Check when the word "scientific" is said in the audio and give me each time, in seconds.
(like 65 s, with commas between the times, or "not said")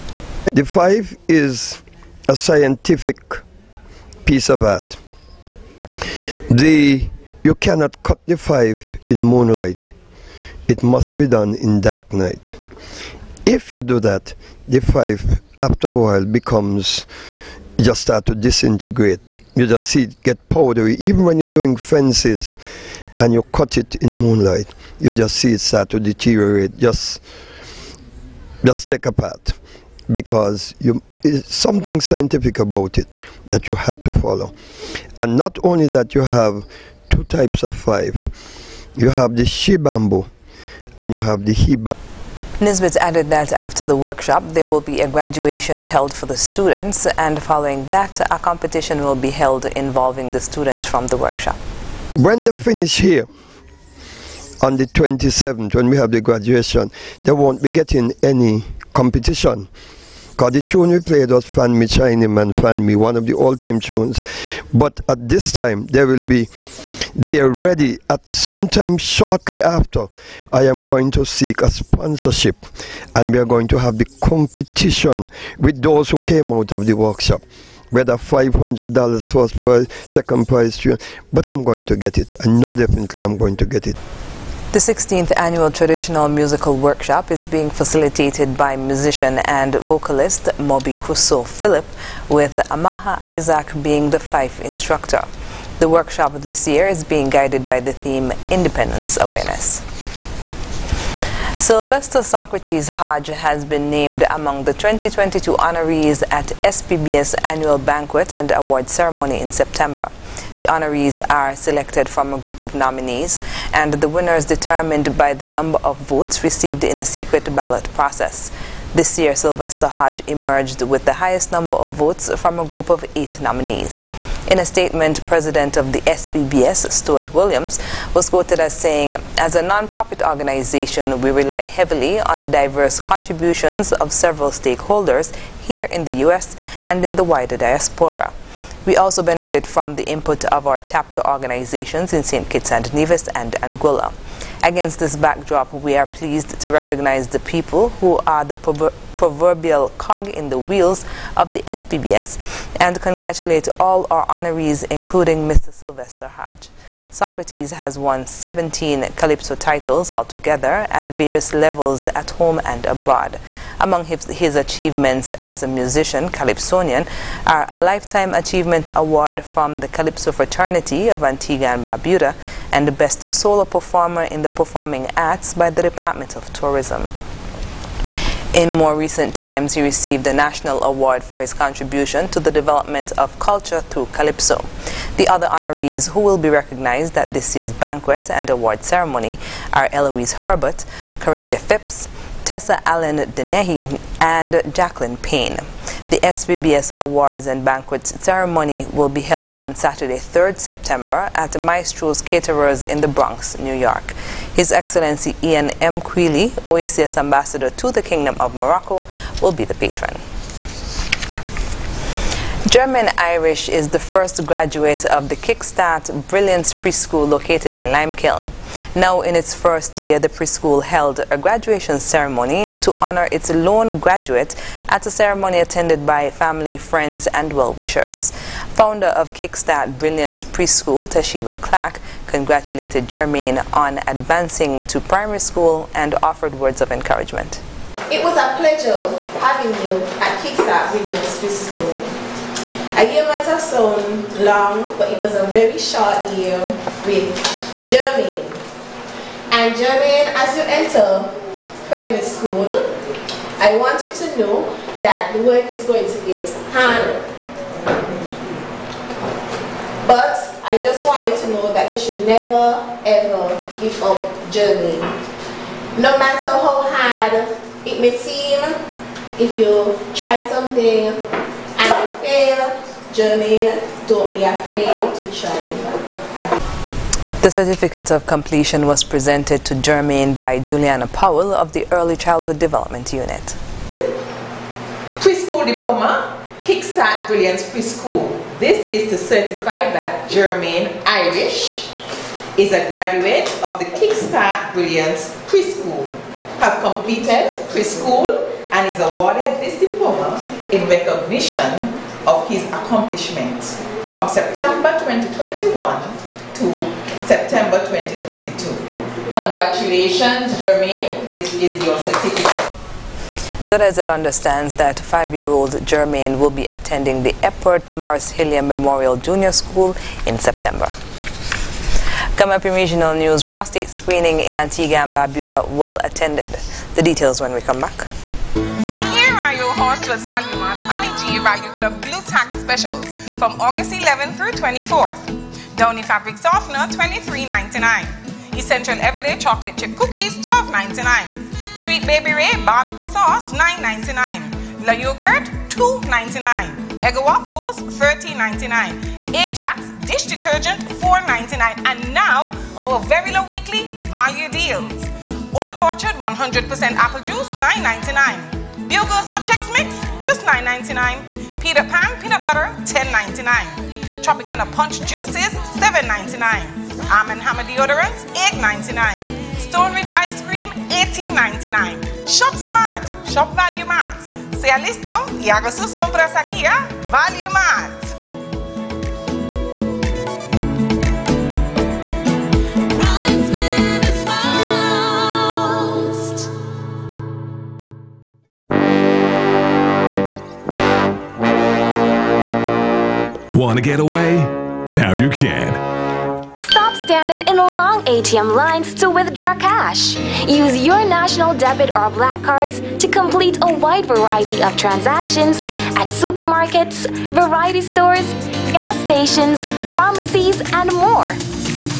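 2 s, 31 s.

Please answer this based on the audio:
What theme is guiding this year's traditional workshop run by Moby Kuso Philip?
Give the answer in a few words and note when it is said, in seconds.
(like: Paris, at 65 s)
Independence Awareness, at 98 s.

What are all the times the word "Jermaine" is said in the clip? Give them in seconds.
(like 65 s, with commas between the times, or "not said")
310 s, 315 s.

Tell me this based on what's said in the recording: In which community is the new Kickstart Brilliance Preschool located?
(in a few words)
Limekiln.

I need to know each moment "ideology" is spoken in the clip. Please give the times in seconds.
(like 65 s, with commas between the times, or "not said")
not said.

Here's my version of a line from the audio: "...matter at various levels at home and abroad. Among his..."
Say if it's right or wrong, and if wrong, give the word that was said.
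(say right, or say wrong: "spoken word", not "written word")
wrong: "altogether", not "matter".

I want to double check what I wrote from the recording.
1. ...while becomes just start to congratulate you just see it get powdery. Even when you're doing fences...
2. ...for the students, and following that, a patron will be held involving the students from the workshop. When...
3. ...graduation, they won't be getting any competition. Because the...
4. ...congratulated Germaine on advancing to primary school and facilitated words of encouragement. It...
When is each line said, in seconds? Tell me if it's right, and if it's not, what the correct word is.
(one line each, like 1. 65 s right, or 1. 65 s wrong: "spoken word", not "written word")
1. 15 s wrong: "disintegrate", not "congratulate"
2. 46 s wrong: "competition", not "patron"
3. 56 s right
4. 232 s wrong: "offered", not "facilitated".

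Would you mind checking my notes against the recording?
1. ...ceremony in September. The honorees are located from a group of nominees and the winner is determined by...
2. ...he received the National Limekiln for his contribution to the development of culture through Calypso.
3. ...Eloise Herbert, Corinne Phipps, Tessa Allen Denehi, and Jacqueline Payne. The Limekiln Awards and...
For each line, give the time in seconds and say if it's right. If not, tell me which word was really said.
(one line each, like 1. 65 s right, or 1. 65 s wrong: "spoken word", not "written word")
1. 108 s wrong: "selected", not "located"
2. 179 s wrong: "Award", not "Limekiln"
3. 189 s wrong: "SBBS", not "Limekiln".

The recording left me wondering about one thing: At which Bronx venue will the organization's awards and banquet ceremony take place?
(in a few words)
Maestro's Caterers.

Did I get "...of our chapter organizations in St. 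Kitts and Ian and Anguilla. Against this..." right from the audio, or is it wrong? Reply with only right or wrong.
wrong.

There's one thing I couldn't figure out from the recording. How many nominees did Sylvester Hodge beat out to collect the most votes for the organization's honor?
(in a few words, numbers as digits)
8.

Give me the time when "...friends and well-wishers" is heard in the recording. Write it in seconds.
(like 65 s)
226 s.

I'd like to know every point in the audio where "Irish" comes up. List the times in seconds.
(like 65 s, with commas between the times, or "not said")
213 s, 291 s.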